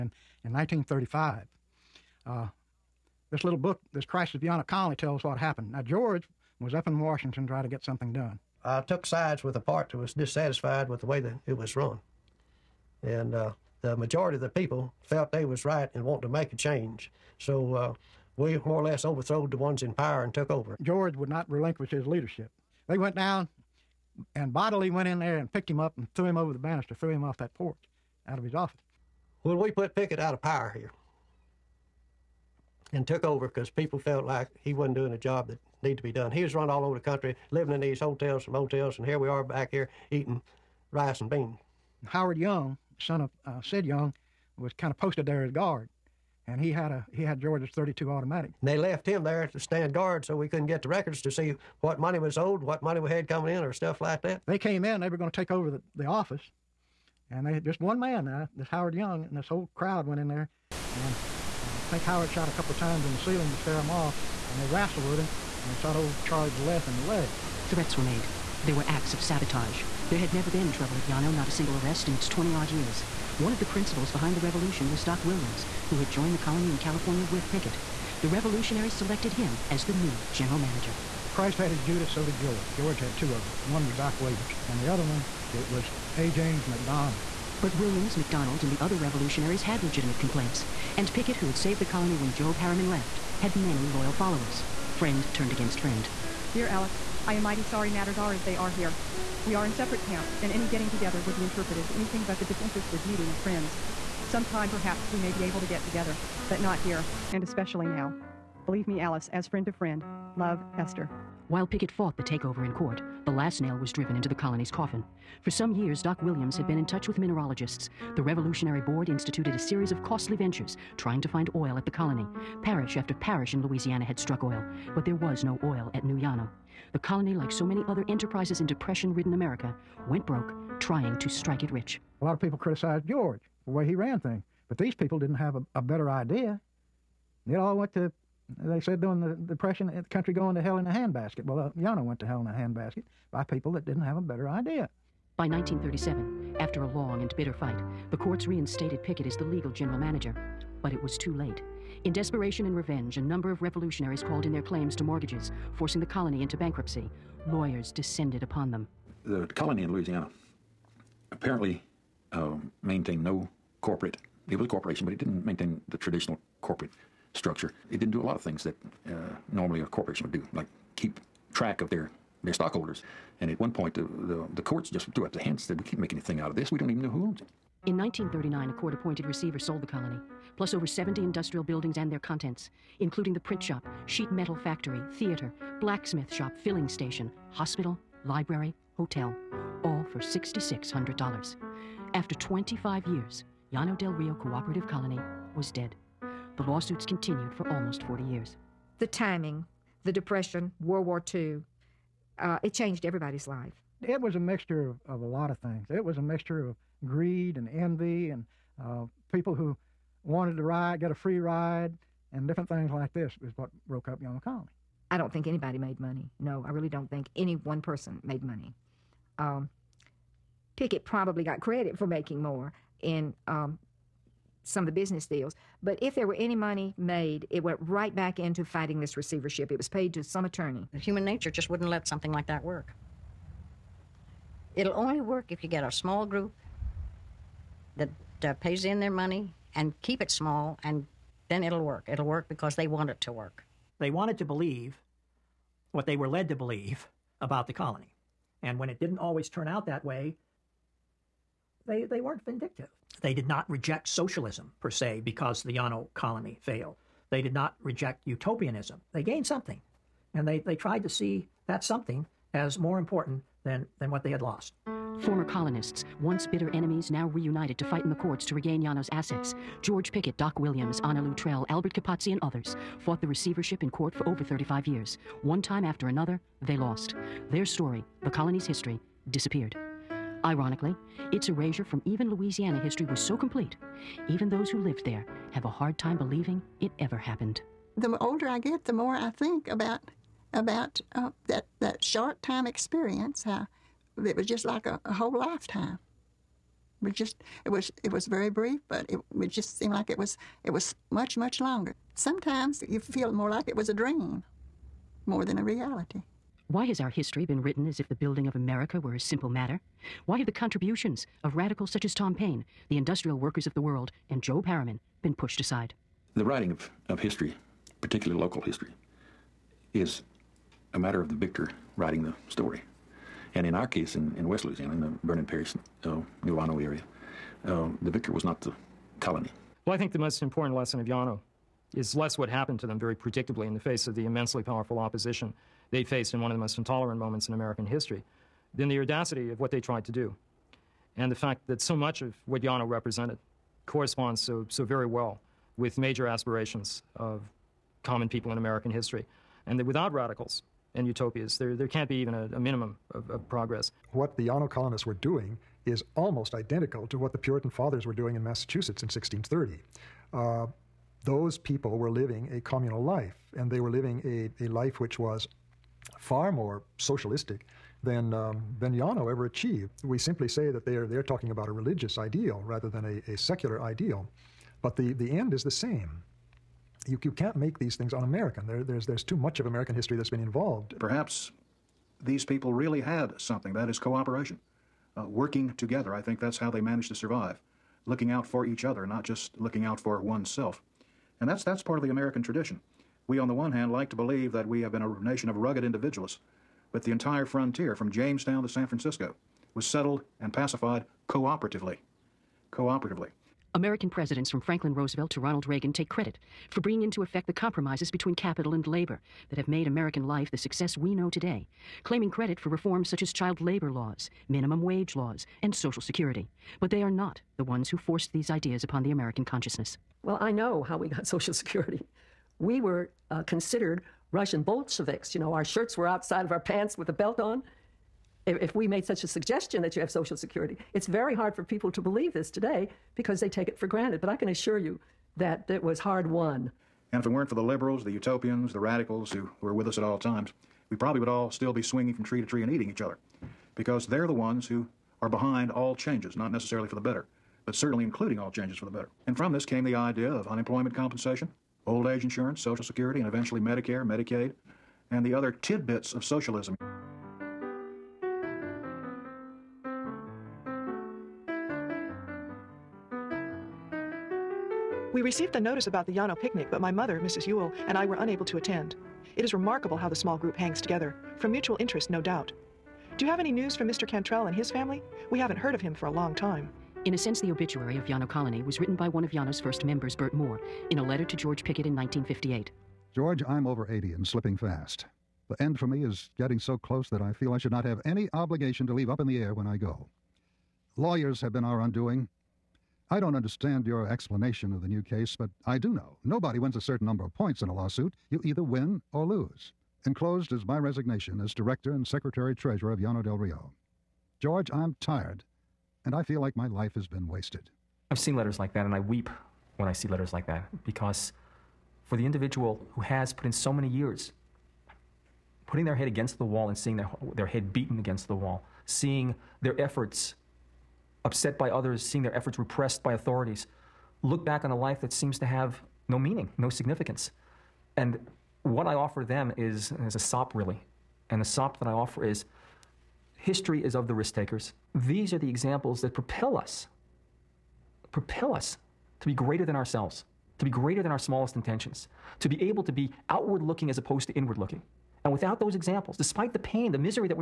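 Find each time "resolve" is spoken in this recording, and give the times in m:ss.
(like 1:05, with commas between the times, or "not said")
not said.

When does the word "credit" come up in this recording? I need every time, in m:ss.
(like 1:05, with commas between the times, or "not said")
3:41, 6:46, 6:52.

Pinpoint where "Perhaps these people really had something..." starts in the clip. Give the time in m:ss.
6:20.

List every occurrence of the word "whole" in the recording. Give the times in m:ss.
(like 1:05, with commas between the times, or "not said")
0:59, 4:55.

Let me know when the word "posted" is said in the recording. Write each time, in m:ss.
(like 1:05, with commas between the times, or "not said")
0:44.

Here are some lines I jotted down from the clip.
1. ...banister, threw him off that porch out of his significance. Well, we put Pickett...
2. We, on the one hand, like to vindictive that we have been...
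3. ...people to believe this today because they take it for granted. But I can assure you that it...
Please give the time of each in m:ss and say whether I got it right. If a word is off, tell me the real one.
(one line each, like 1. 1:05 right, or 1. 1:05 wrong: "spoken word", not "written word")
1. 0:26 wrong: "office", not "significance"
2. 6:33 wrong: "believe", not "vindictive"
3. 7:11 right.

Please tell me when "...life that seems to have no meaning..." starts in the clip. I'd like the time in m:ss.
8:44.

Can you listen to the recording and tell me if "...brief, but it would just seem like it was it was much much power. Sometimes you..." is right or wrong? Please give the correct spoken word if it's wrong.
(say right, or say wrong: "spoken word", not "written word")
wrong: "longer", not "power".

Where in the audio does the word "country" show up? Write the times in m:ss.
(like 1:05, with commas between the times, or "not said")
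0:36, 2:20.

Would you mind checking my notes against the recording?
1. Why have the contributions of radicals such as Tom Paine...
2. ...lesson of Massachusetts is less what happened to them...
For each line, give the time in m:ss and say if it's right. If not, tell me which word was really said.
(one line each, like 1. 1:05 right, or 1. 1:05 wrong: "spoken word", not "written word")
1. 5:10 right
2. 5:30 wrong: "Llano", not "Massachusetts".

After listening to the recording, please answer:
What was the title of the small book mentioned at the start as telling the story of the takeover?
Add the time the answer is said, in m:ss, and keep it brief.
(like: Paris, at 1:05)
Crisis of a Colony, at 0:04.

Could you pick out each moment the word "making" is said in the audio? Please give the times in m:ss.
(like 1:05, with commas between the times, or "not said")
3:42.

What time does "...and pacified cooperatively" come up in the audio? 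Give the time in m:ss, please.
6:40.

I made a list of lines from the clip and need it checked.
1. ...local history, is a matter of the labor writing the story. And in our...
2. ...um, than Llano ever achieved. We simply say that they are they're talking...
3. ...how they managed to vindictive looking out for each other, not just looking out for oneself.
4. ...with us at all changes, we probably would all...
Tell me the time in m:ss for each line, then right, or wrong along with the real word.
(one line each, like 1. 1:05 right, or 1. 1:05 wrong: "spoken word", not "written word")
1. 5:18 wrong: "victor", not "labor"
2. 6:08 right
3. 6:26 wrong: "survive", not "vindictive"
4. 7:19 wrong: "times", not "changes".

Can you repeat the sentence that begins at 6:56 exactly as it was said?
But they are not the ones who forced these ideas upon the American consciousness.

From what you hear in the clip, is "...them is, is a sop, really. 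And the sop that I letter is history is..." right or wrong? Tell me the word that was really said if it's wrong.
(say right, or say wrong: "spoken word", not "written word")
wrong: "offer", not "letter".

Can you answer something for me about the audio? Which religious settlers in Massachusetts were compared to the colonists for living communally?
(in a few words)
Puritan fathers.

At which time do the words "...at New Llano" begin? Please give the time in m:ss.
2:05.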